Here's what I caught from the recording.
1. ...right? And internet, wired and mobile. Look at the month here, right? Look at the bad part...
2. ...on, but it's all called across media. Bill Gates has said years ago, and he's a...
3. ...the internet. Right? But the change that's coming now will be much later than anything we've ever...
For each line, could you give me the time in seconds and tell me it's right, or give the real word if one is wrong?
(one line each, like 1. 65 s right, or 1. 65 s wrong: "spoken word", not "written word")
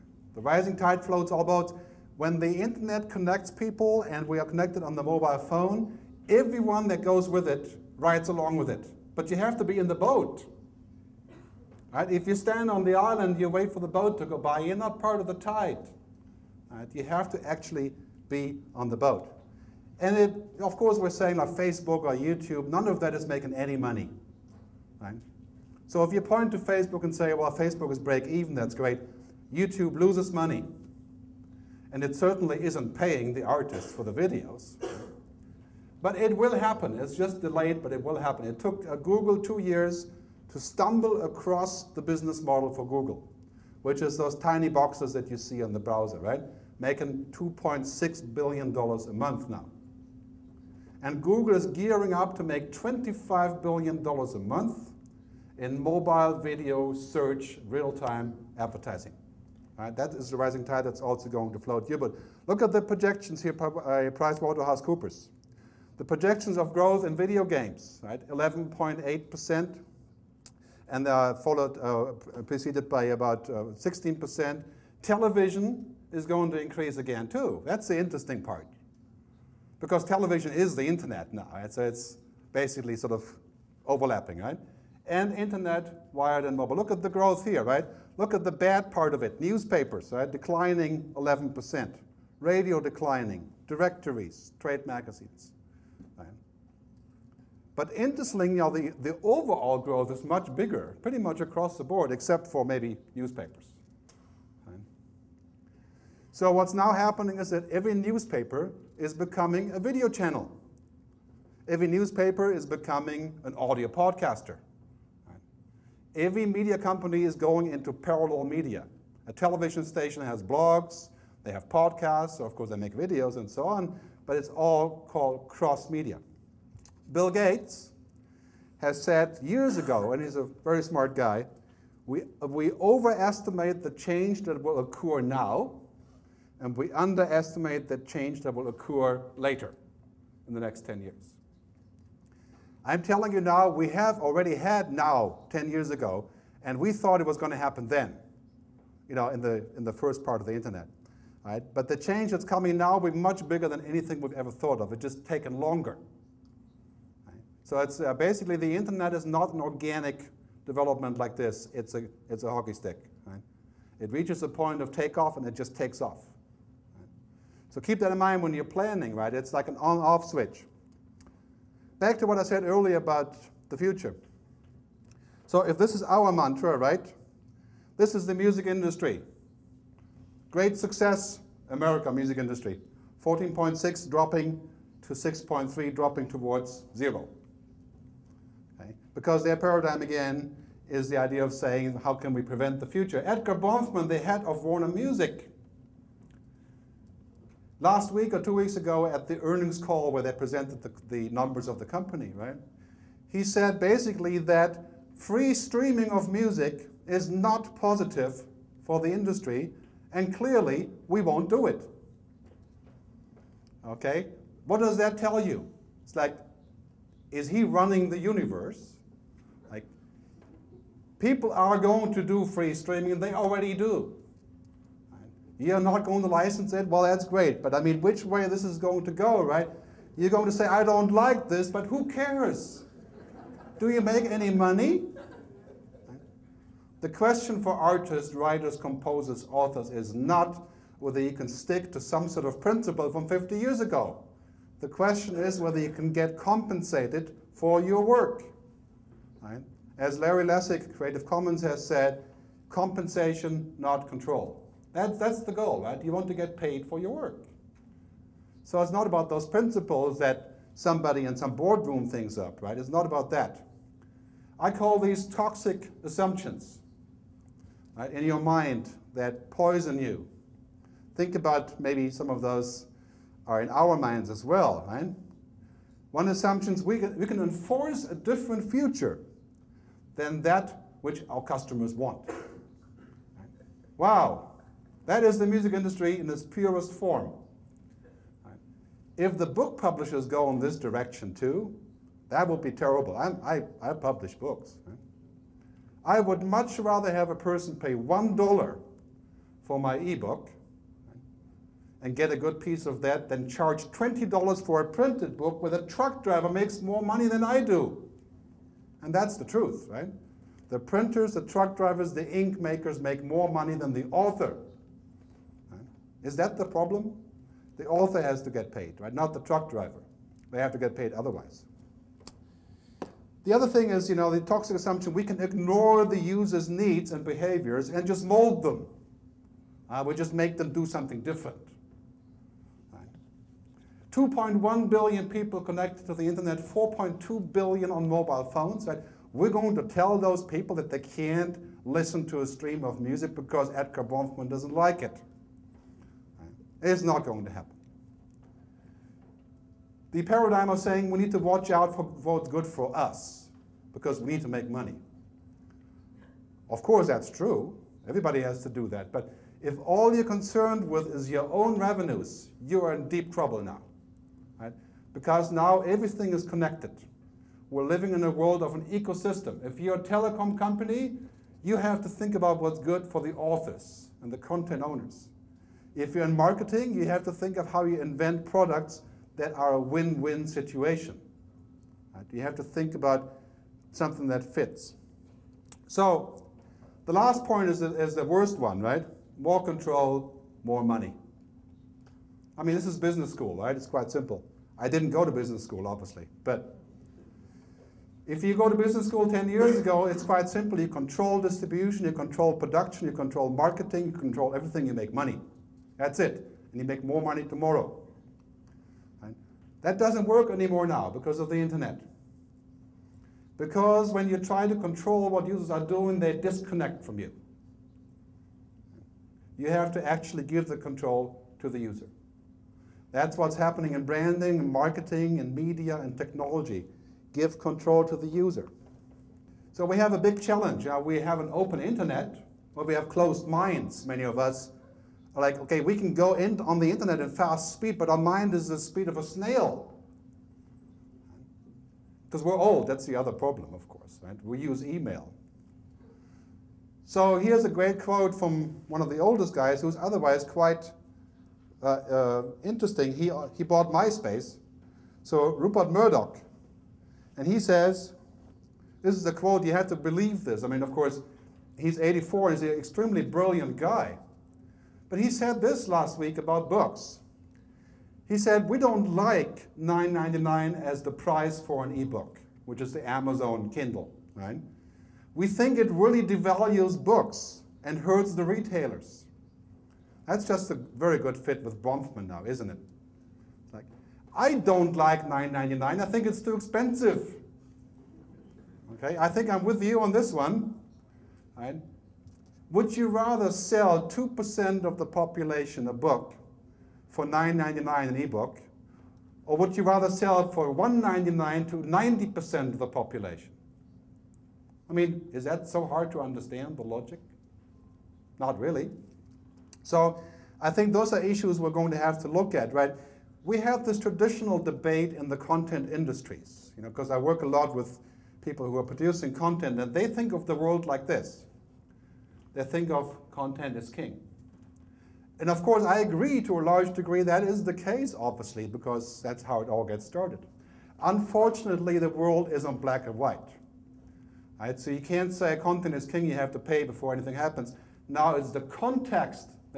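1. 84 s wrong: "growth", not "month"
2. 123 s wrong: "cross", not "across"
3. 150 s wrong: "bigger", not "later".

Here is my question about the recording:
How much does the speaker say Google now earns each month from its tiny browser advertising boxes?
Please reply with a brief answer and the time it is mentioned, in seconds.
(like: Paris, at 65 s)
$2.6 billion, at 47 s.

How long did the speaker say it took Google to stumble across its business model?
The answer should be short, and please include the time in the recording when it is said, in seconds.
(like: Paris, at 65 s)
2 years, at 39 s.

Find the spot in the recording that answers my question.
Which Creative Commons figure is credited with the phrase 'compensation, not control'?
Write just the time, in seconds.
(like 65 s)
250 s.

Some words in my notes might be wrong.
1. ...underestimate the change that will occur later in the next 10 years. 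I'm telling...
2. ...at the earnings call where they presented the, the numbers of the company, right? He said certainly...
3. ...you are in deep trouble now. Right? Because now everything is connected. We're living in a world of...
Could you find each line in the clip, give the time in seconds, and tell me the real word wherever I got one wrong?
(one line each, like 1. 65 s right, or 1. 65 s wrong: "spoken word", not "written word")
1. 136 s right
2. 199 s wrong: "basically", not "certainly"
3. 362 s right.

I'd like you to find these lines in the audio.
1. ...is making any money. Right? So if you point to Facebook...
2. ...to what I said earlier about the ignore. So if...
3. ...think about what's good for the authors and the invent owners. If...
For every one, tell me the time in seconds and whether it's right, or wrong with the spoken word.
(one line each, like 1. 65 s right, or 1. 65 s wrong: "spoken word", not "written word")
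1. 23 s right
2. 172 s wrong: "future", not "ignore"
3. 372 s wrong: "content", not "invent".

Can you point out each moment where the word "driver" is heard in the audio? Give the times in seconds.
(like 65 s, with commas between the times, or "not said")
306 s, 311 s, 319 s.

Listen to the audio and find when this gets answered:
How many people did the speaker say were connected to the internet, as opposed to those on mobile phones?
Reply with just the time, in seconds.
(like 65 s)
334 s.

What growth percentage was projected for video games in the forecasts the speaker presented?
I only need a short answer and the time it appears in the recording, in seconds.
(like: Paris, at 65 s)
11.8%, at 68 s.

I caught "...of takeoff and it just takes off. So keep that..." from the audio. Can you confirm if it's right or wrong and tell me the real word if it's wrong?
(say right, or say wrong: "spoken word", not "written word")
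right.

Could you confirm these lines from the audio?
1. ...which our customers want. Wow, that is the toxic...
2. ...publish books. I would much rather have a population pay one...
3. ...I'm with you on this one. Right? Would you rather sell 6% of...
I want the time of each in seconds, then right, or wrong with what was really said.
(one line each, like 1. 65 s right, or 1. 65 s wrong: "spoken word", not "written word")
1. 281 s wrong: "music", not "toxic"
2. 293 s wrong: "person", not "population"
3. 489 s wrong: "2", not "6".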